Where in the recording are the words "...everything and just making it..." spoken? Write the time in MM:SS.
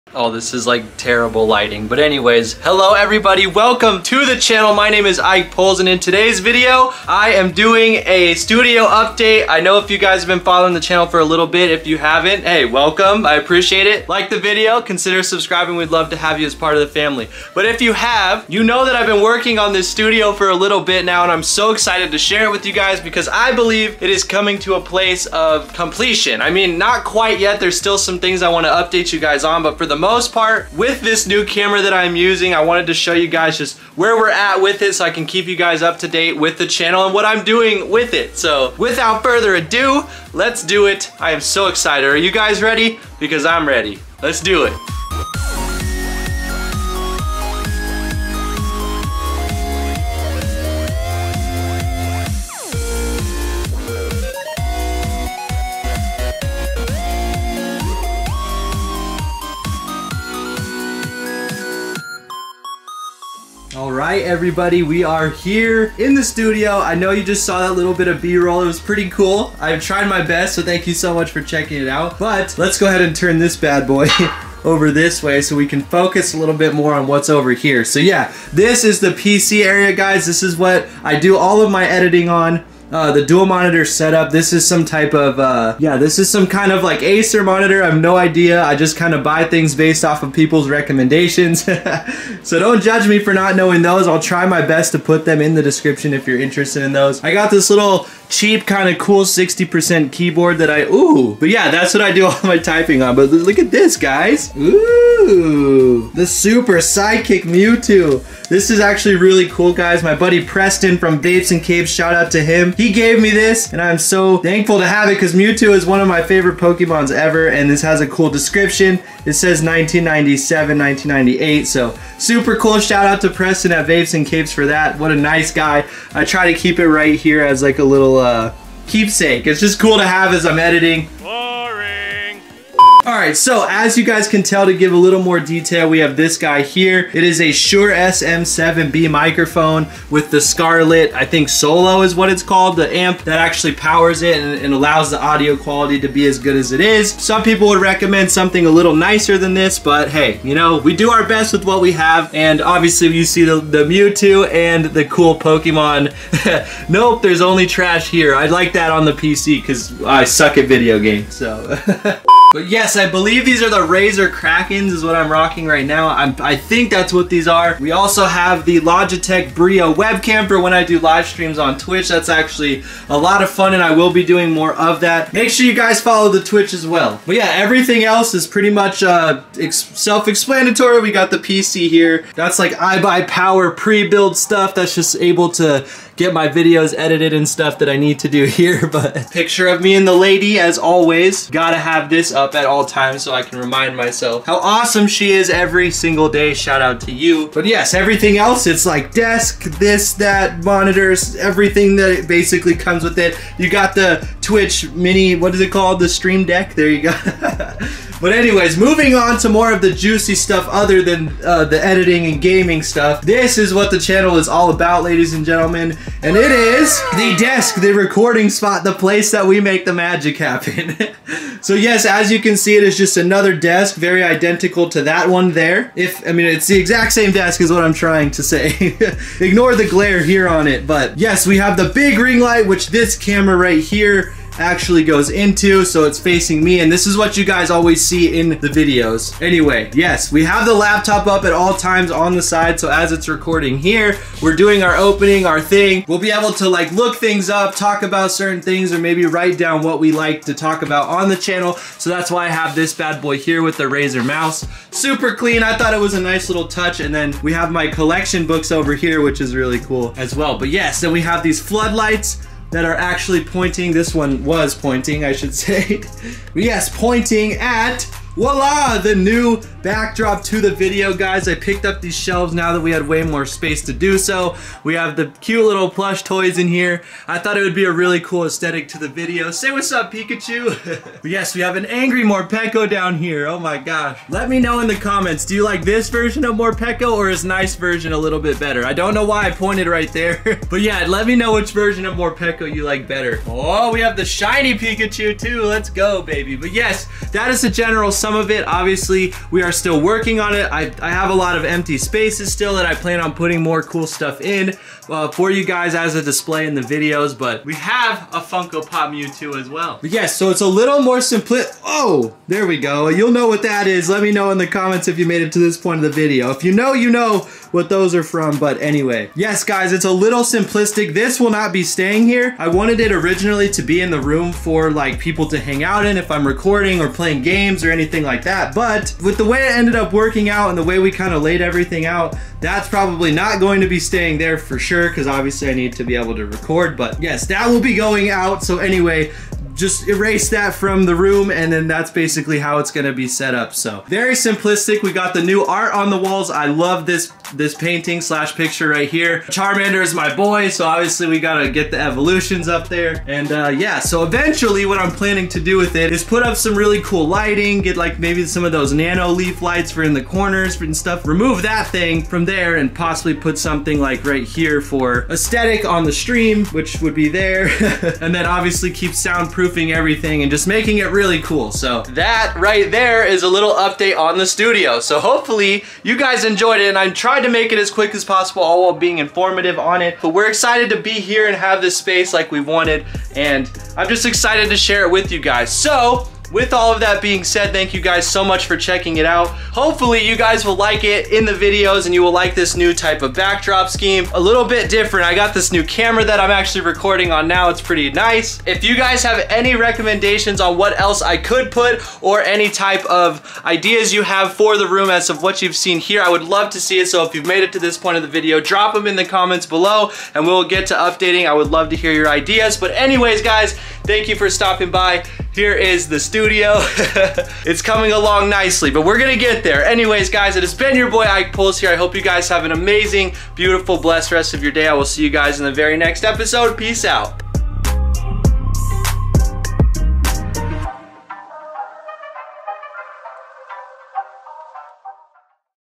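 06:09.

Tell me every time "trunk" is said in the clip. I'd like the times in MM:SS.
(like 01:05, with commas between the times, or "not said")
not said.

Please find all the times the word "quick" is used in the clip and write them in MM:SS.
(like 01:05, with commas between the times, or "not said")
06:17.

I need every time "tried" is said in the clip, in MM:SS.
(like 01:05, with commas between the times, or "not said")
01:09, 06:17.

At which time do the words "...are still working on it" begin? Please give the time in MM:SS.
04:59.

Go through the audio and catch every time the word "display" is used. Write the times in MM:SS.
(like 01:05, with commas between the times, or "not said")
05:06.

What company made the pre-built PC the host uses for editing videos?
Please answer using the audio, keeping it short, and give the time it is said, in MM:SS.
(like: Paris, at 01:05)
iBuyPower, at 03:02.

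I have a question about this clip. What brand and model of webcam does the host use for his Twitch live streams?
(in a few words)
Logitech Brio.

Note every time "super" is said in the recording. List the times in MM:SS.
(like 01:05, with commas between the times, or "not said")
01:46, 02:02, 04:14.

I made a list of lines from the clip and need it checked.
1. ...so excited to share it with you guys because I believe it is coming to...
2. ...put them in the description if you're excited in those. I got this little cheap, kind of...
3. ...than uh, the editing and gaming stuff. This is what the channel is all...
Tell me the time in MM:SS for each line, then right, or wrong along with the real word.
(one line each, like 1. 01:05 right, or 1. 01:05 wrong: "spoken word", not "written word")
1. 00:21 right
2. 01:34 wrong: "interested", not "excited"
3. 03:31 right.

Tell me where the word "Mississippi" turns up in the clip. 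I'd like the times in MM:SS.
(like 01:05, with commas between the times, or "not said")
not said.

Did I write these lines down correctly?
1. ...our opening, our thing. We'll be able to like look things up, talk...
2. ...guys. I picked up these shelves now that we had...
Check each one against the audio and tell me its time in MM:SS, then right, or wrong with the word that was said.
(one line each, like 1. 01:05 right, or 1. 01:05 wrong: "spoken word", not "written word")
1. 04:04 right
2. 04:31 right.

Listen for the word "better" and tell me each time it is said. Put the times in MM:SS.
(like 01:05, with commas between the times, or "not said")
04:48, 04:53.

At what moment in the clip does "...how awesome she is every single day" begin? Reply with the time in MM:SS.
03:14.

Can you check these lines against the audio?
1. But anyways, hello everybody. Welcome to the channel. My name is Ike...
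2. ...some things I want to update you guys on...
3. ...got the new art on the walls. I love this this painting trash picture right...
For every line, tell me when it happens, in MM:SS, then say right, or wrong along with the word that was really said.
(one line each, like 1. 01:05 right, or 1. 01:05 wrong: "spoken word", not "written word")
1. 00:01 right
2. 00:27 right
3. 05:45 wrong: "slash", not "trash".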